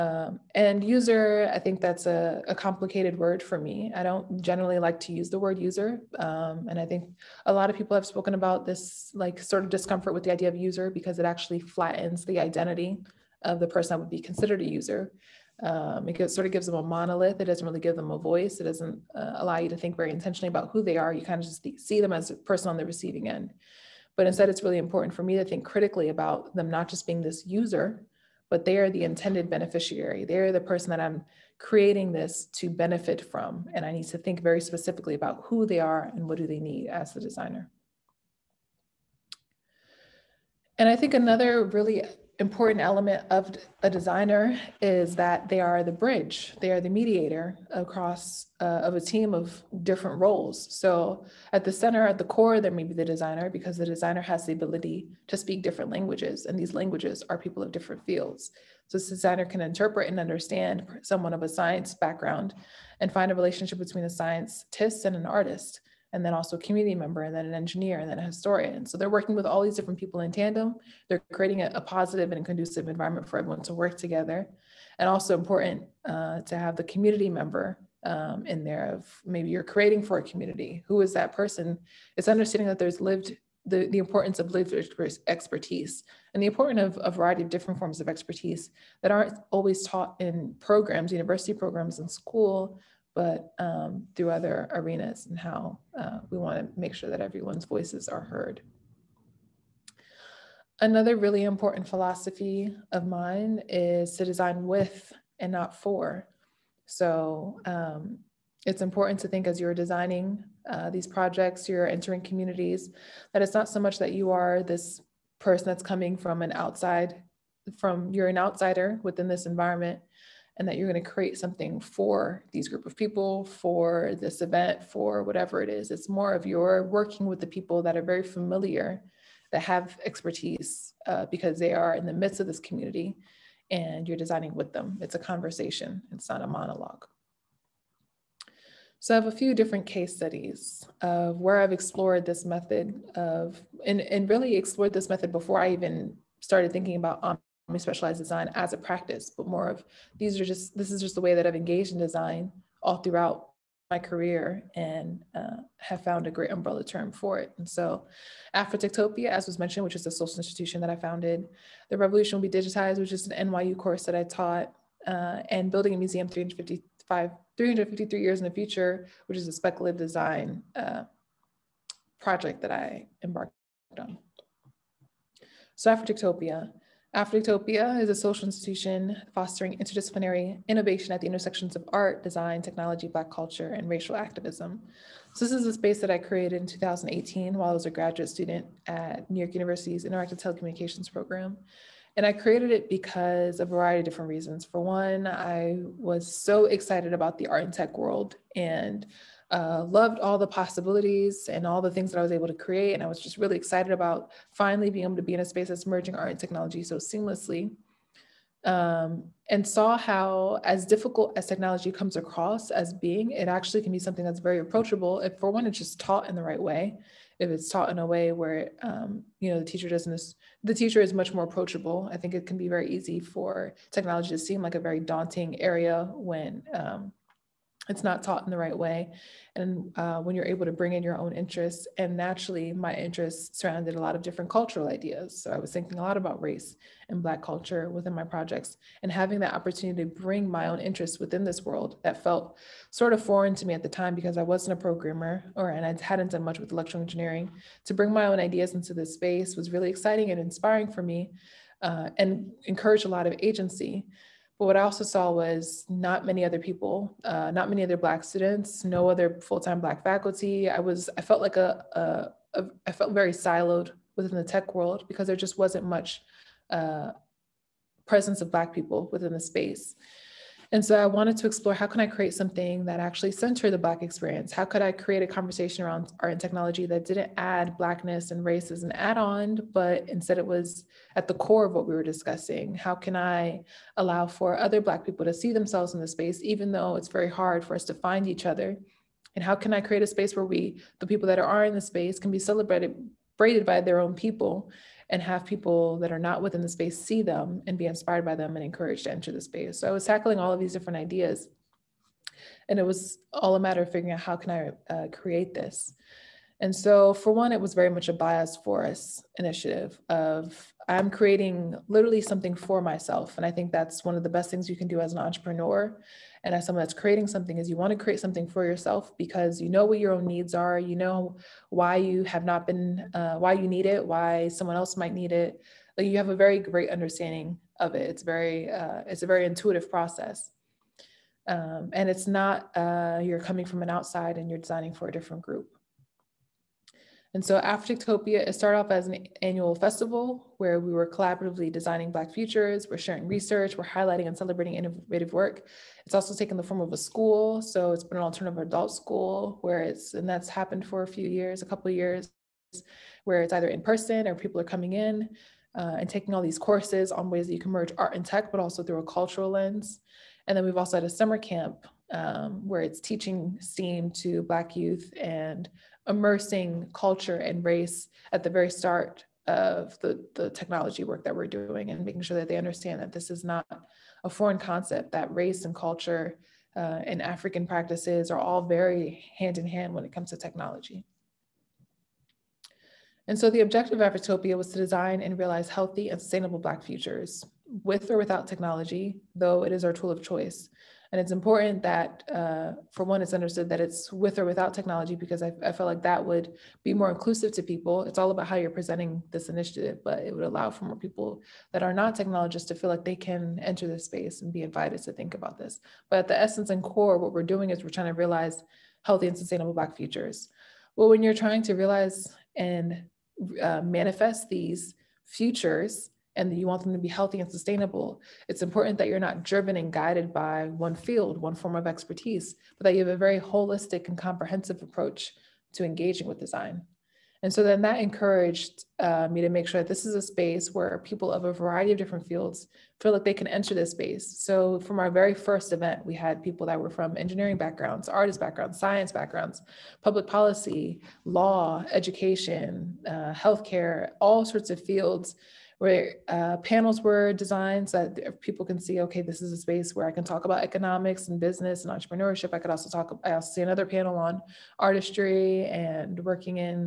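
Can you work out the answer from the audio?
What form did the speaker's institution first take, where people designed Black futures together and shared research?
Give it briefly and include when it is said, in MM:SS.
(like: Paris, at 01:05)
annual festival, at 05:39.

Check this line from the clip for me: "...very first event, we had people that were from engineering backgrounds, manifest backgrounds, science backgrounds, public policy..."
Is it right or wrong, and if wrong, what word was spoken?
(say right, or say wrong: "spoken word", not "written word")
wrong: "artist", not "manifest".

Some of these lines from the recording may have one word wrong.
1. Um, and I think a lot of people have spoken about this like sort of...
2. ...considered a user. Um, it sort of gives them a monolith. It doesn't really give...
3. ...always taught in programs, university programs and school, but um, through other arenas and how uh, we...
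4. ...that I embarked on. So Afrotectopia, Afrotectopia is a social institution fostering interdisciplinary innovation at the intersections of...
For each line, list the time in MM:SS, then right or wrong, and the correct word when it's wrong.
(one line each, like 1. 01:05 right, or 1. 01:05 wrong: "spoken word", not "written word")
1. 00:06 right
2. 00:14 right
3. 01:29 right
4. 02:52 right.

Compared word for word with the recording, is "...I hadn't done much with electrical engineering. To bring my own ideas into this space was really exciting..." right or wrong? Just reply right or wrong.
right.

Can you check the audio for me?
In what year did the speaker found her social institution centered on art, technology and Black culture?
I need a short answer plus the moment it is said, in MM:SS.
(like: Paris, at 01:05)
2018, at 03:06.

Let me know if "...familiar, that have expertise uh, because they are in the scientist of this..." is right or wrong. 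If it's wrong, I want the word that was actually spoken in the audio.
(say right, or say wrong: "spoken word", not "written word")
wrong: "midst", not "scientist".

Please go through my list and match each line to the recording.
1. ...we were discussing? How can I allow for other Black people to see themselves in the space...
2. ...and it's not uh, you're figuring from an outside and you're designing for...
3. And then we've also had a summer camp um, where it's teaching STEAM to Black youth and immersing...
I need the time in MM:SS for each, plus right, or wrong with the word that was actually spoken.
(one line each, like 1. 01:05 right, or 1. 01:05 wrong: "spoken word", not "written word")
1. 04:41 right
2. 05:31 wrong: "coming", not "figuring"
3. 06:00 right.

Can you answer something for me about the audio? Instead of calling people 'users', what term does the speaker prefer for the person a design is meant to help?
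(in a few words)
intended beneficiary.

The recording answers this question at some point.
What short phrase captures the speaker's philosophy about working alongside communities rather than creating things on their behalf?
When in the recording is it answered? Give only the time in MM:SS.
01:44.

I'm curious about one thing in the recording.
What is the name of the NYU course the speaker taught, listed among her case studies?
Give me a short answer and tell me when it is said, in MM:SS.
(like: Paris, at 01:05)
The Revolution Will Be Digitized, at 02:41.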